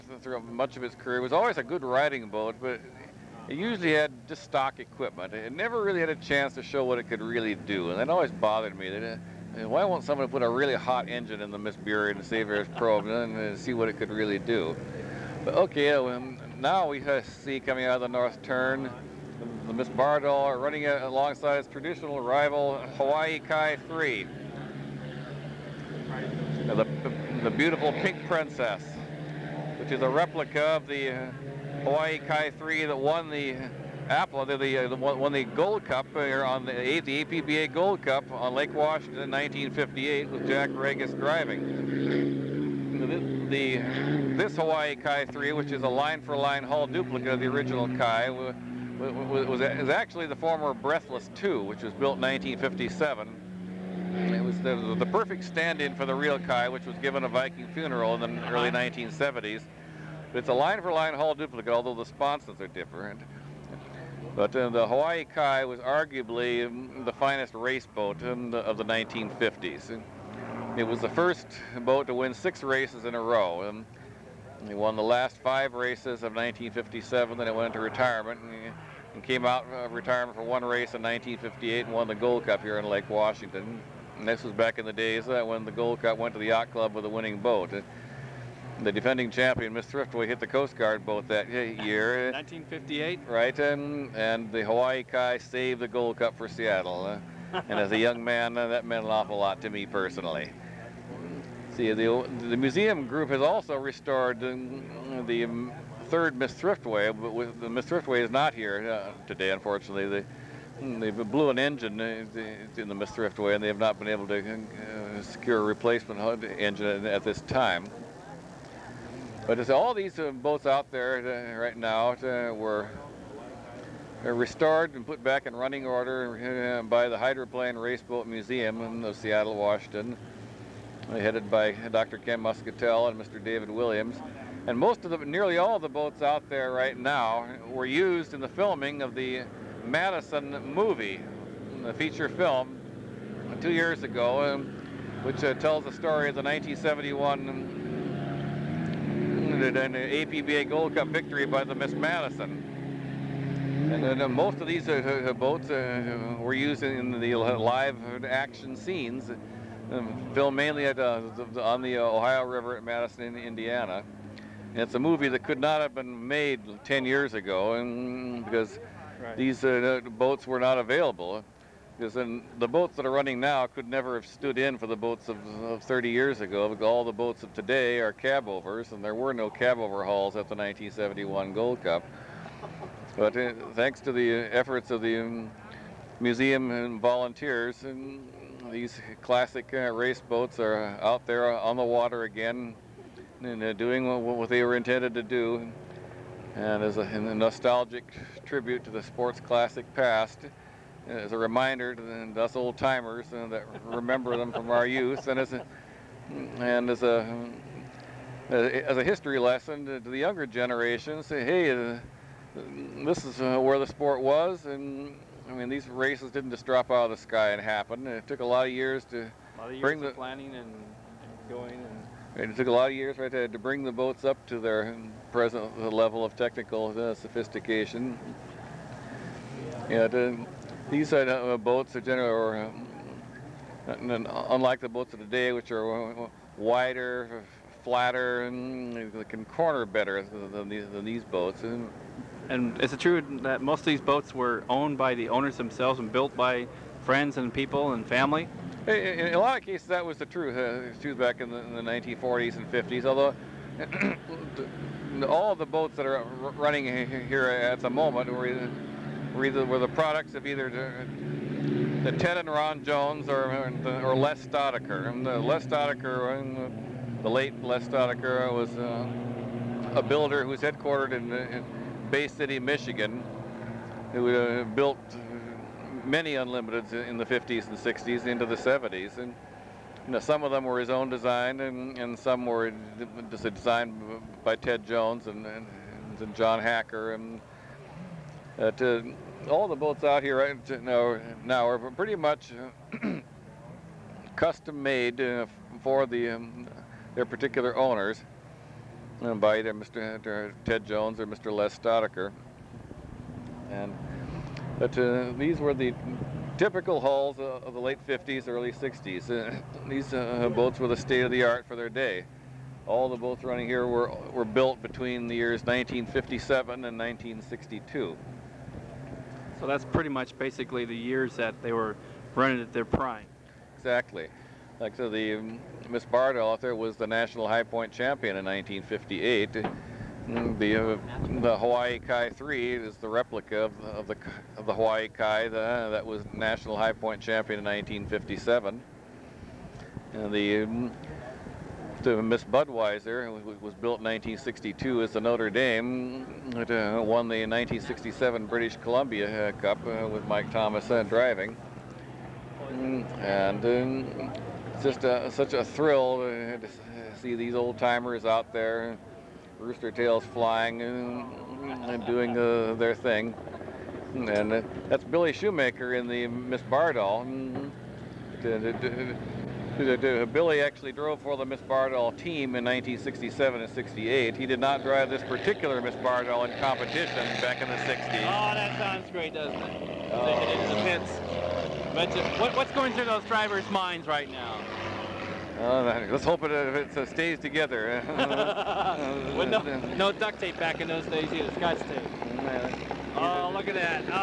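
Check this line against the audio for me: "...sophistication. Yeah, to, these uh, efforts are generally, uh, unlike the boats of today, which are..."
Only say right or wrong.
wrong.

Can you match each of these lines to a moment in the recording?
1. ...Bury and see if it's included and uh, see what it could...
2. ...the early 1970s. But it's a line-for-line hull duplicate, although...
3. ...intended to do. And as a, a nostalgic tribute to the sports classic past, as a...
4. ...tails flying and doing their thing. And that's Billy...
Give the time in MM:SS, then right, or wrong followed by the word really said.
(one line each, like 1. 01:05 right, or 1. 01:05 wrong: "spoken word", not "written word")
1. 00:11 wrong: "probed", not "included"
2. 00:58 right
3. 03:14 right
4. 05:59 right.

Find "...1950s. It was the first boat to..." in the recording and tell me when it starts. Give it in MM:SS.
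01:08.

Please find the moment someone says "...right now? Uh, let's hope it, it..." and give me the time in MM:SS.
06:24.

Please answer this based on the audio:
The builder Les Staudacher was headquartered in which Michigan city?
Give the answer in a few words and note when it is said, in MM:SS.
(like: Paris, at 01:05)
Bay City, at 04:32.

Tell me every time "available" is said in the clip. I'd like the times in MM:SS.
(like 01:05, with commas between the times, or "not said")
02:50.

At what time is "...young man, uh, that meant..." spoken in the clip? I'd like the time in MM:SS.
01:37.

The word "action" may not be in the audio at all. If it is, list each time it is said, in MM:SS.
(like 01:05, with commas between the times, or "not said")
02:38.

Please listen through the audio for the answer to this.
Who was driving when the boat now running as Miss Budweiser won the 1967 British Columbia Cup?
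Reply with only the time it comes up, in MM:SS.
05:50.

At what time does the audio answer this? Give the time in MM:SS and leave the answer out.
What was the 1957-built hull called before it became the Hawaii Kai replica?
00:50.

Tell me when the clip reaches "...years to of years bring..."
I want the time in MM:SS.
03:38.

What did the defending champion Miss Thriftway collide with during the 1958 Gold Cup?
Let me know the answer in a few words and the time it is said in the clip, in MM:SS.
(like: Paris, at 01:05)
The Coast Guard boat, at 01:30.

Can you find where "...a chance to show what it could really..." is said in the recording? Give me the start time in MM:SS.
00:06.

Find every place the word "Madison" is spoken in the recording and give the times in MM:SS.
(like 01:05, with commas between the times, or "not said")
02:19, 02:31, 02:42.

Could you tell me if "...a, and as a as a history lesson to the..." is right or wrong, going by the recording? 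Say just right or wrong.
right.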